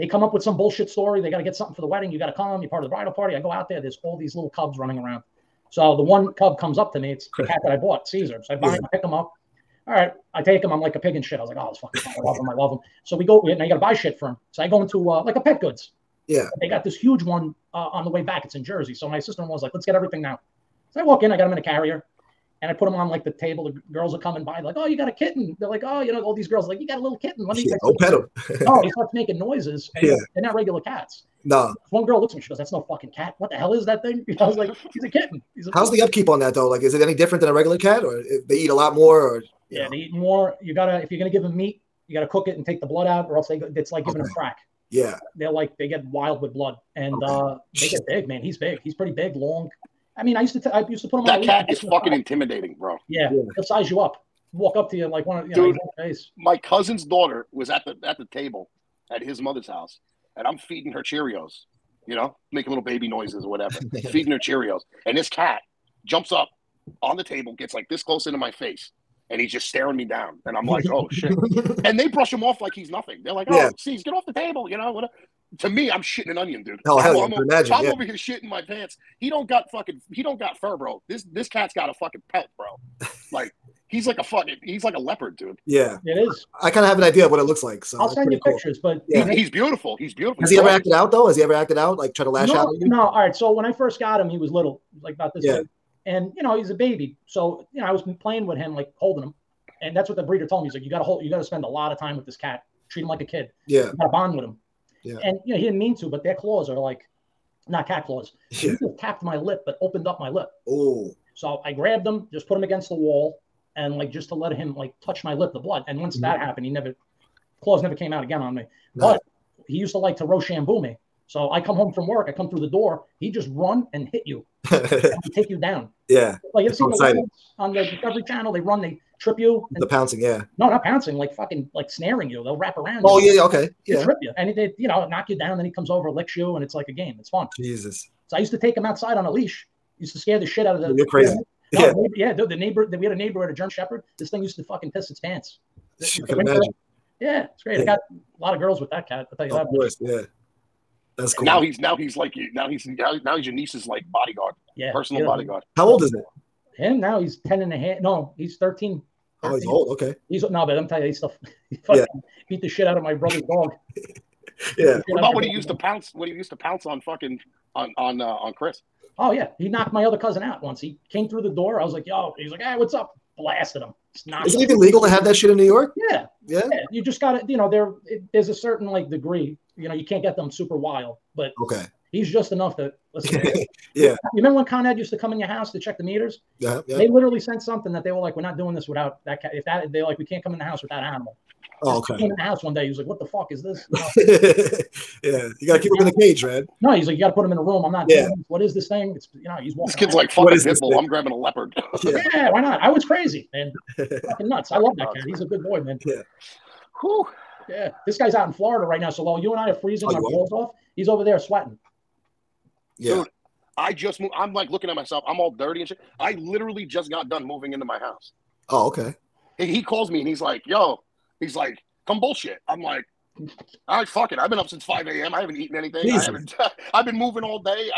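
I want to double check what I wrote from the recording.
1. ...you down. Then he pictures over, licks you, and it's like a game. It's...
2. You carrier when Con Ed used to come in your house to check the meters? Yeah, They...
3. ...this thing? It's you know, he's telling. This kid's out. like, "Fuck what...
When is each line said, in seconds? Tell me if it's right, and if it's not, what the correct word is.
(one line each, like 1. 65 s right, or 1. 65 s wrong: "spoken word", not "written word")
1. 135 s wrong: "comes", not "pictures"
2. 184 s wrong: "remember", not "carrier"
3. 198 s wrong: "walking", not "telling".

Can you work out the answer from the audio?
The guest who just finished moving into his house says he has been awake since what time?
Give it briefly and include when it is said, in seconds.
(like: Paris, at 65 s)
5 a.m., at 224 s.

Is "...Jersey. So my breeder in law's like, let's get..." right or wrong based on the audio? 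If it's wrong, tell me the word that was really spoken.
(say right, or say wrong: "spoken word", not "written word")
wrong: "sister", not "breeder".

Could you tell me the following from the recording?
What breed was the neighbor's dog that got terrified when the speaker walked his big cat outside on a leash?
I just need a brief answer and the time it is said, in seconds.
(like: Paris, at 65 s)
German Shepherd, at 143 s.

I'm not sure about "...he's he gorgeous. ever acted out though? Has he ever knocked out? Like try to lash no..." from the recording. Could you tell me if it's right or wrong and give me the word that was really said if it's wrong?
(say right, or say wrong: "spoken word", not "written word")
wrong: "acted", not "knocked".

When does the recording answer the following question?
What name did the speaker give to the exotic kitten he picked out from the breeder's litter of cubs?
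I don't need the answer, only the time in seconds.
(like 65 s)
8 s.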